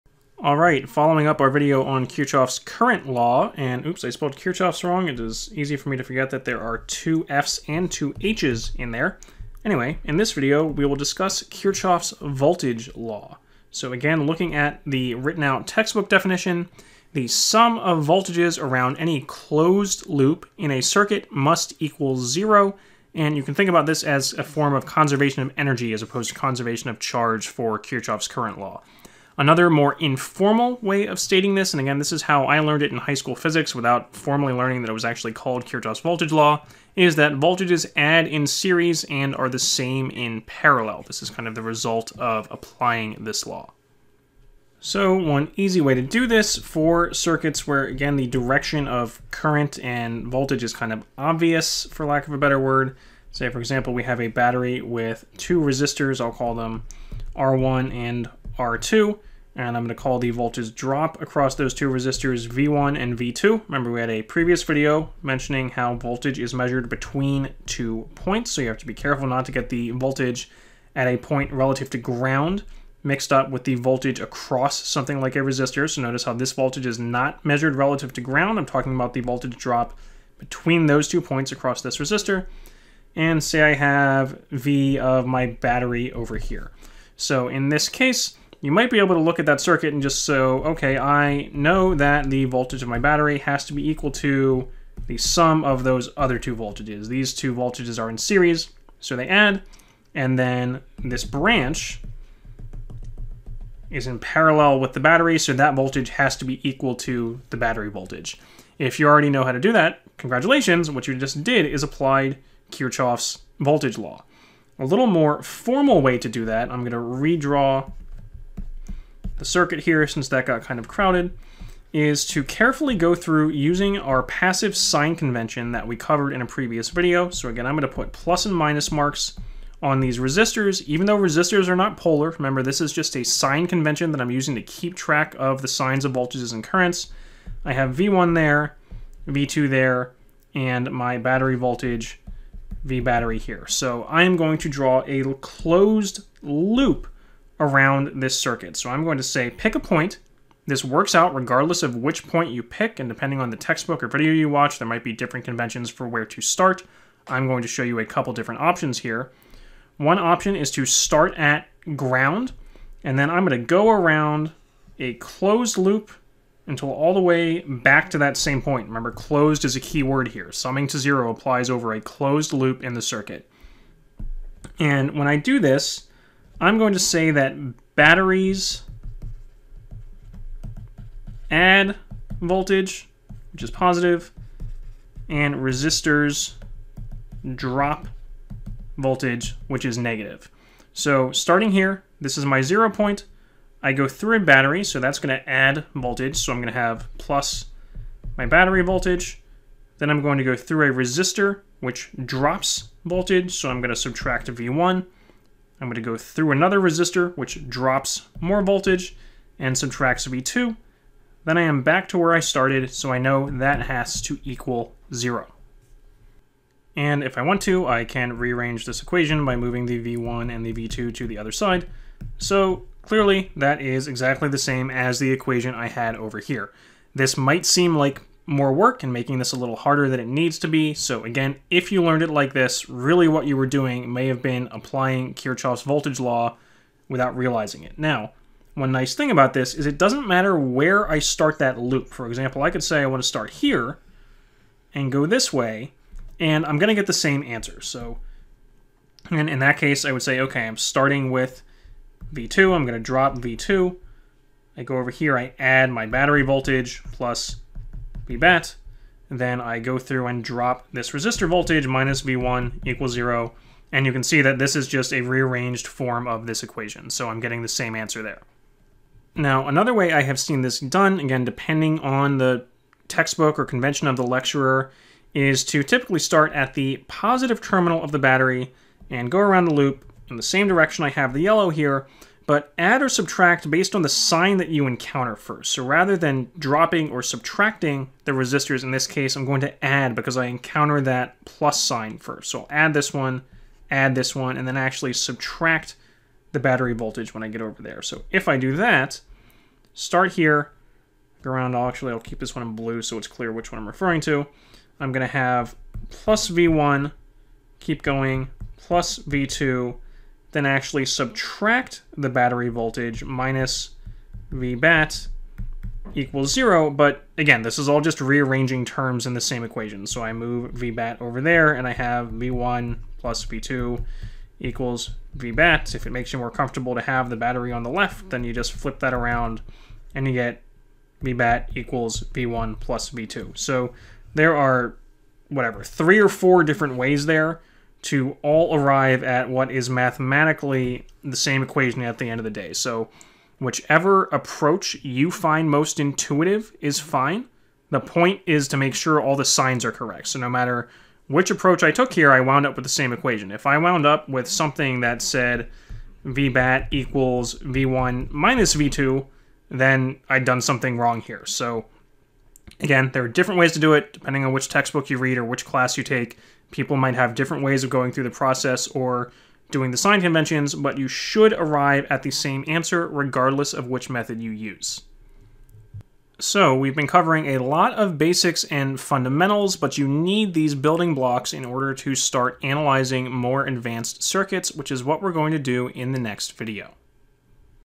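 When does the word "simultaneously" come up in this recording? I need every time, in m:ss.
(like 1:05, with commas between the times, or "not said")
not said.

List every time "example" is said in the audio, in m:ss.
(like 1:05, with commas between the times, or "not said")
0:53, 4:02.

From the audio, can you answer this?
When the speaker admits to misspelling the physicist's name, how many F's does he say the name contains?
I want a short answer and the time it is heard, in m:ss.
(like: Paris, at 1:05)
2, at 0:06.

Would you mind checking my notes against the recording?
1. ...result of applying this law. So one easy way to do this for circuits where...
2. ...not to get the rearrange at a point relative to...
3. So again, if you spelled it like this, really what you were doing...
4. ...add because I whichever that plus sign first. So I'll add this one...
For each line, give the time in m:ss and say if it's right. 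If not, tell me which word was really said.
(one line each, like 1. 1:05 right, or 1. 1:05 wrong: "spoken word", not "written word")
1. 0:41 right
2. 1:09 wrong: "voltage", not "rearrange"
3. 3:50 wrong: "learned", not "spelled"
4. 4:49 wrong: "encounter", not "whichever".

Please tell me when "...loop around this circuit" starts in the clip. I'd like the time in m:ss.
2:26.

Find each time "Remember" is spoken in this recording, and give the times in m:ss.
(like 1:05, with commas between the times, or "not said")
1:03, 2:12, 2:48.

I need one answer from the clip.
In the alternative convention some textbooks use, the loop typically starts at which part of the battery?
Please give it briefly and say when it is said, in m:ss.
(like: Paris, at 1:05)
Positive terminal, at 4:37.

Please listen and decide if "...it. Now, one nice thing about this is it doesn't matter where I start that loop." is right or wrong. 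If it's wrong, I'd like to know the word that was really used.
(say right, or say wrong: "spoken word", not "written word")
right.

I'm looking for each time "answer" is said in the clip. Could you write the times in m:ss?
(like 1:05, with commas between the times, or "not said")
4:07, 4:27, 6:12.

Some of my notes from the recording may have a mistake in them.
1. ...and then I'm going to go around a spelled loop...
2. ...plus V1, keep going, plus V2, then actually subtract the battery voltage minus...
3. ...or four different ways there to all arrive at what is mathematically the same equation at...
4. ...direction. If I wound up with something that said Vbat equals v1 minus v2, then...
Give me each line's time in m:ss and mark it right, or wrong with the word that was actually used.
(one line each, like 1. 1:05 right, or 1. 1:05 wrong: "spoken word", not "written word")
1. 2:43 wrong: "closed", not "spelled"
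2. 5:06 right
3. 5:36 right
4. 5:53 wrong: "equation", not "direction".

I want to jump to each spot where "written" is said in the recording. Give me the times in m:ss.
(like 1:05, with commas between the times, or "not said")
0:15.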